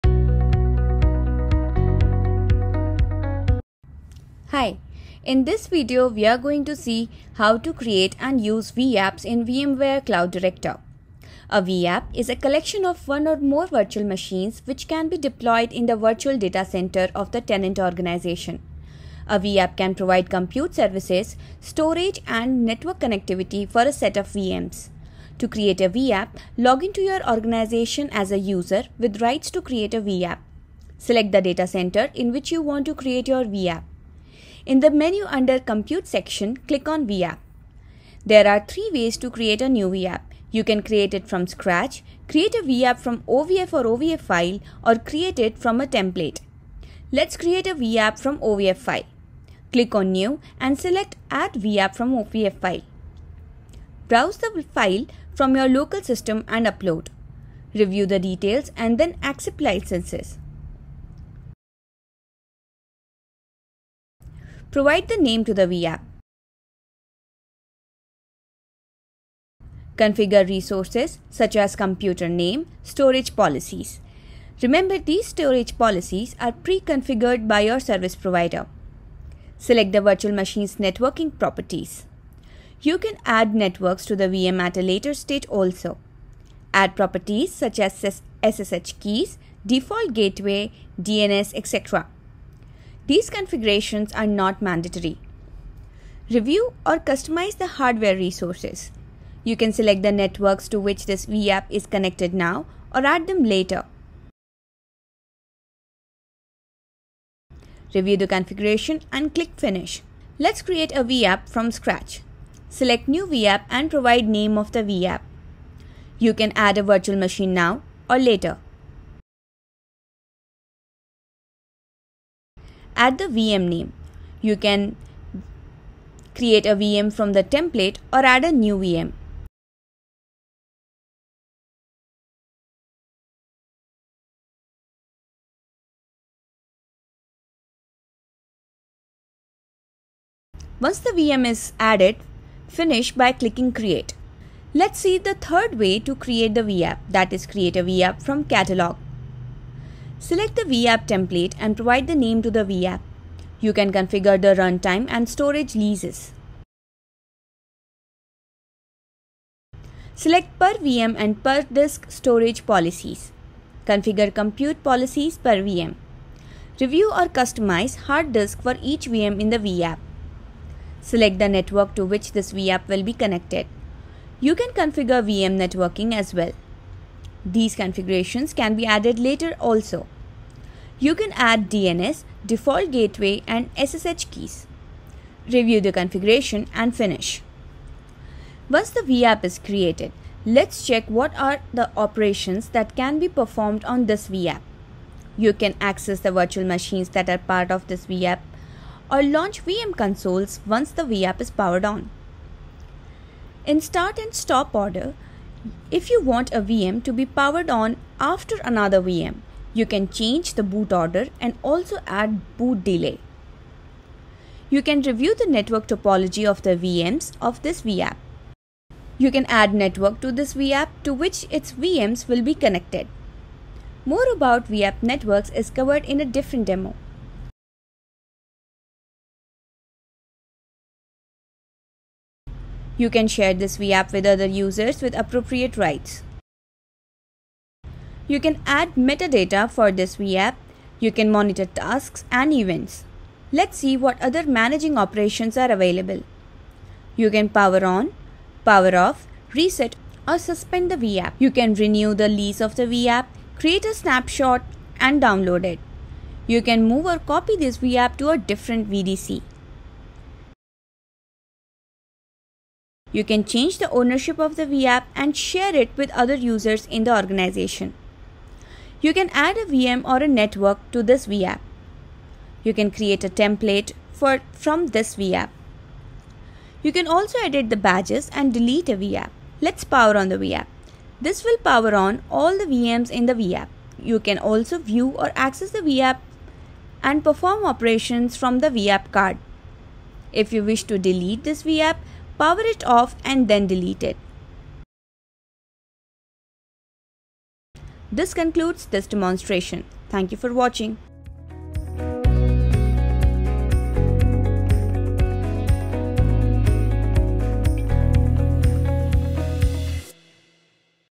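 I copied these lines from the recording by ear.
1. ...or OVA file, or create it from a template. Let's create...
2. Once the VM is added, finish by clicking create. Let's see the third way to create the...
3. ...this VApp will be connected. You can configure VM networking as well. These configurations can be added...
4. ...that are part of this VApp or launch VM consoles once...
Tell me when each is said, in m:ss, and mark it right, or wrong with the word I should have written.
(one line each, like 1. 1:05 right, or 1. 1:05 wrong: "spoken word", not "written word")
1. 0:43 right
2. 2:20 right
3. 2:52 right
4. 3:17 right.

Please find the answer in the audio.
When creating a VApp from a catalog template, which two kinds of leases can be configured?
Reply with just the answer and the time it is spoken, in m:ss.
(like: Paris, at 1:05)
Runtime and storage, at 2:34.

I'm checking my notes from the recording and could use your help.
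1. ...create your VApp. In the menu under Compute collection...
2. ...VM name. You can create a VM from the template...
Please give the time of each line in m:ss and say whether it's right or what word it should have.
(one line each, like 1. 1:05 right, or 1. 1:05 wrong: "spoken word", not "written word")
1. 0:32 wrong: "section", not "collection"
2. 2:03 right.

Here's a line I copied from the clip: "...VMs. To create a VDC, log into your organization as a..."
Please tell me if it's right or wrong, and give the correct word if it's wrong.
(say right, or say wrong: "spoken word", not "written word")
wrong: "VApp", not "VDC".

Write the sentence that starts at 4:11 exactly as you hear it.
You can renew the lease of the VApp, create a snapshot and download it.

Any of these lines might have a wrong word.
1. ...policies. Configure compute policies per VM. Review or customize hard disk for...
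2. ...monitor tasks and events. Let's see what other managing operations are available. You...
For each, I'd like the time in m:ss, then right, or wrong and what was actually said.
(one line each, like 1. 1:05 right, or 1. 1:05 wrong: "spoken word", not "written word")
1. 2:42 right
2. 4:01 right.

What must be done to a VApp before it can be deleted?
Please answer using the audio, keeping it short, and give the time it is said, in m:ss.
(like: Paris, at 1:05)
Power it off, at 4:52.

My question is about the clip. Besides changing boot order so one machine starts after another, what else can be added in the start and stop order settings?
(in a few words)
Boot delay.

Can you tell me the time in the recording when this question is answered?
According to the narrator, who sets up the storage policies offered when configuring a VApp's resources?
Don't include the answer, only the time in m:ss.
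1:17.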